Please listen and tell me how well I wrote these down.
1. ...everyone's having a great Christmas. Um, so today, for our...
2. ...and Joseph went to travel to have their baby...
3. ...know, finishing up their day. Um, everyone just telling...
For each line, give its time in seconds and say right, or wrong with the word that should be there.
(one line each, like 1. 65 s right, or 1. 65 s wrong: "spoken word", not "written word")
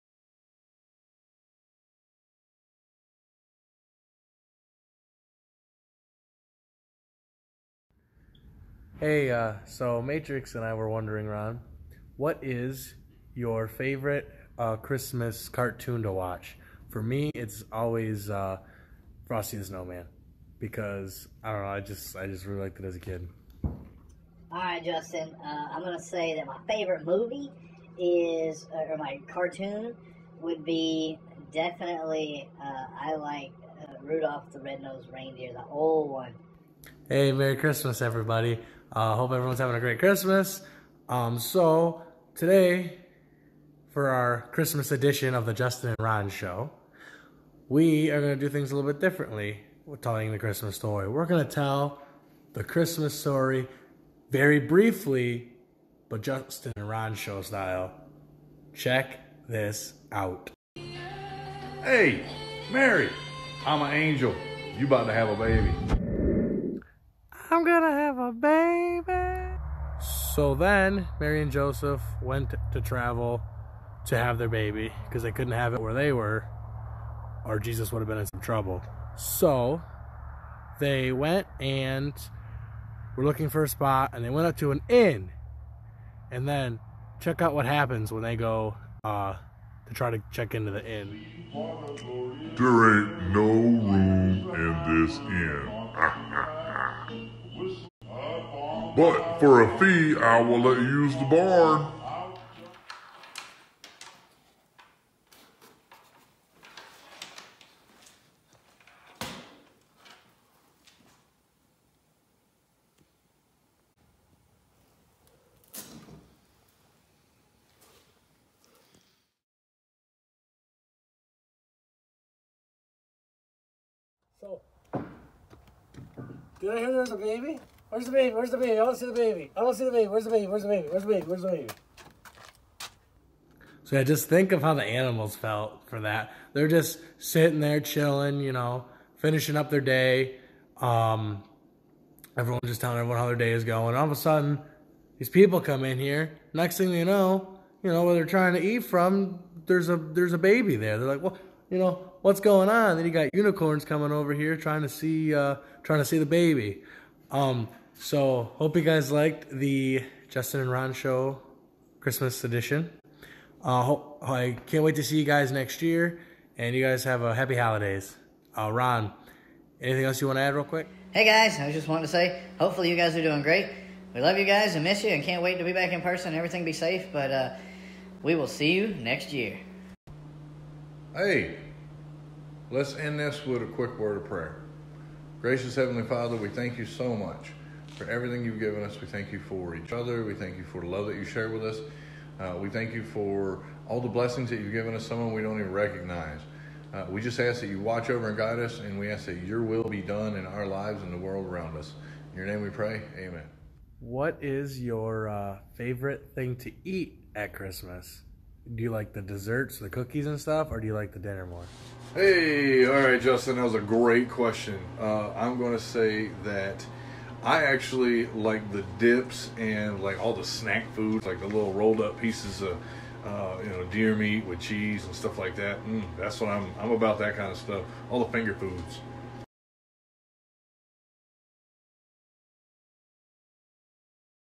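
1. 39 s right
2. 71 s right
3. 138 s right.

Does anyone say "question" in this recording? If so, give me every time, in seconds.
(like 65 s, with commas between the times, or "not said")
214 s.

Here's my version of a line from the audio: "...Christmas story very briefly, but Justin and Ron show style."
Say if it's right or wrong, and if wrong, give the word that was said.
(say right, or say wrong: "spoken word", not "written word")
right.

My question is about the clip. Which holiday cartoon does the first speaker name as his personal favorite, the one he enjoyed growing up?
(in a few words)
Frosty the Snowman.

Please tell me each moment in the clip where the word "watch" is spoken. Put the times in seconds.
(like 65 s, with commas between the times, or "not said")
16 s, 197 s.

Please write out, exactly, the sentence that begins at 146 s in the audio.
Next thing you know, you know where they're trying to eat from.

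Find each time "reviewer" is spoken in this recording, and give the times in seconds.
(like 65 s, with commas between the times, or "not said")
not said.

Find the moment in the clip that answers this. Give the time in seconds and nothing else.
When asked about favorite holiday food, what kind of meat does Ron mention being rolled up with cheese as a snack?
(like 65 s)
223 s.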